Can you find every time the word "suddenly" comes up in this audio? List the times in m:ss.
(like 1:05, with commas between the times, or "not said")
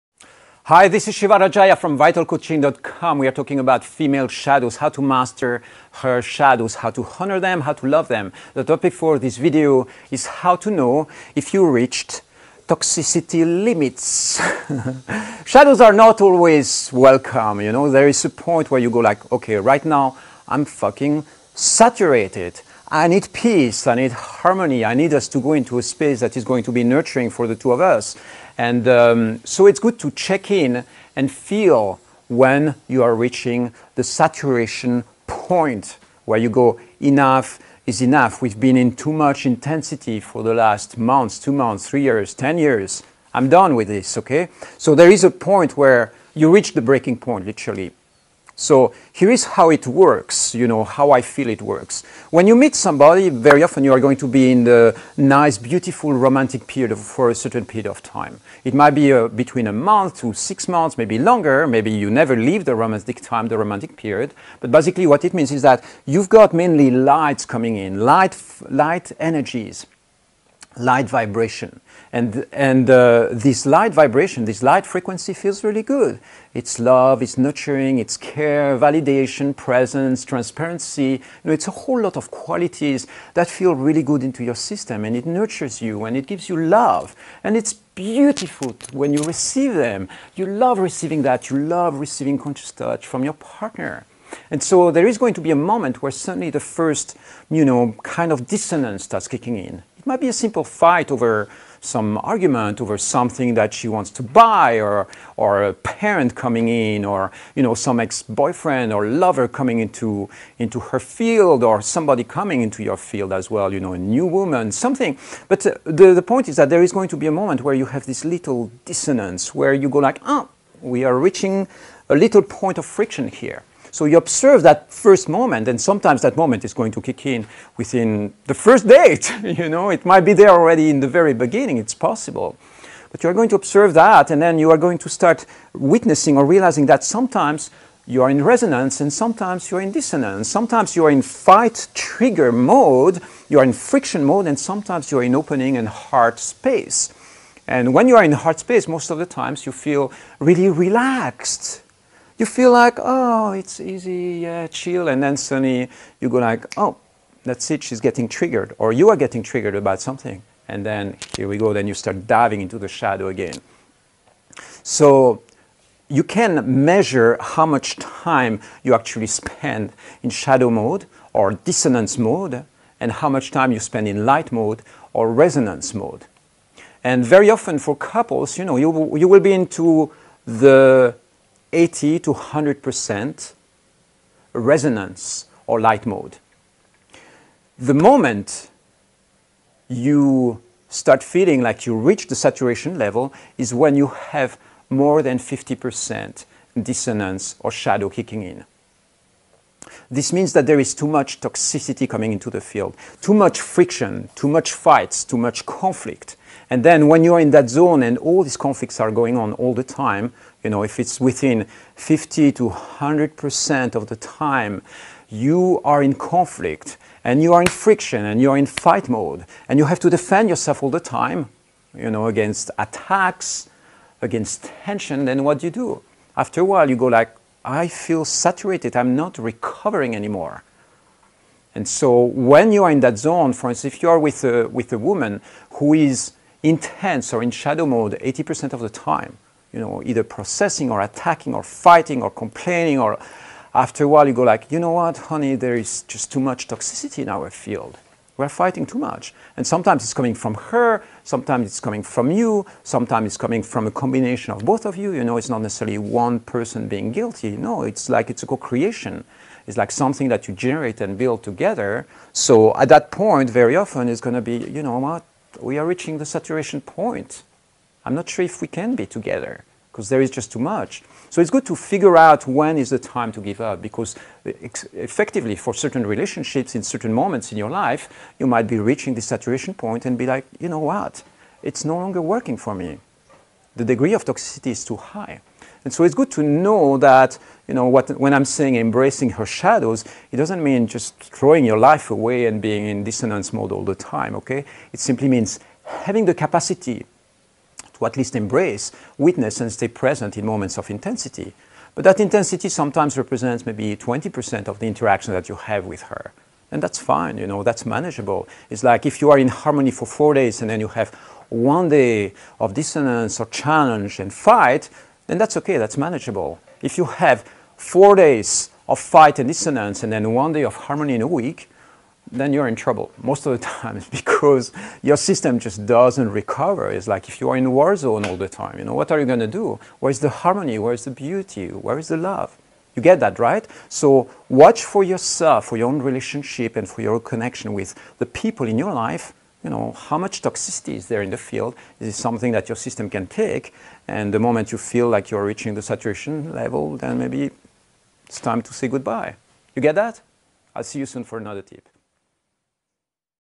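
1:36, 2:35.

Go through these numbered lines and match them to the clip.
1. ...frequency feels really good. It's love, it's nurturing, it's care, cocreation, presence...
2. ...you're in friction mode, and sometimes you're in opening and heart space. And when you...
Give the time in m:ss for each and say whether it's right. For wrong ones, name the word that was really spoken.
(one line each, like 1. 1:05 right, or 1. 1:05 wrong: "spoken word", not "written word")
1. 1:14 wrong: "validation", not "cocreation"
2. 2:23 right.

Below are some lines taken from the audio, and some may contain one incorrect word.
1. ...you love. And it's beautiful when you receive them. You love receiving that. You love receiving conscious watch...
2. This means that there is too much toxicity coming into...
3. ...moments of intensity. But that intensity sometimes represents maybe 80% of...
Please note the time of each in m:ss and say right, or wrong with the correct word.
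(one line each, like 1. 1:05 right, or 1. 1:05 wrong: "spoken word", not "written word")
1. 1:26 wrong: "touch", not "watch"
2. 3:20 right
3. 5:00 wrong: "20", not "80".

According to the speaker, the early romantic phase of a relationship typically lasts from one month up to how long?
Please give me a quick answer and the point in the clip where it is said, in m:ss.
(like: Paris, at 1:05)
6 months, at 1:00.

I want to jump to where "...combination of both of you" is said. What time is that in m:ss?
4:13.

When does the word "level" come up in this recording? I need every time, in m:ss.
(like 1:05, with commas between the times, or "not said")
3:12, 5:46.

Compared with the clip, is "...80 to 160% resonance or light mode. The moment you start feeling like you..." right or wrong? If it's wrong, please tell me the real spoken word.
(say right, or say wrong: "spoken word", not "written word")
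wrong: "100", not "160".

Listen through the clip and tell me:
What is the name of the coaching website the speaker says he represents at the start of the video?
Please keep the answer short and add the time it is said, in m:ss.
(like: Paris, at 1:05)
vitalcoaching.com, at 0:01.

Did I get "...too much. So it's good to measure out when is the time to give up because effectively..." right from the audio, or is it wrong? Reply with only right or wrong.
wrong.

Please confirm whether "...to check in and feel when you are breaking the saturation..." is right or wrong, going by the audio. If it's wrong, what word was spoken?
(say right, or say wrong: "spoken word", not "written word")
wrong: "reaching", not "breaking".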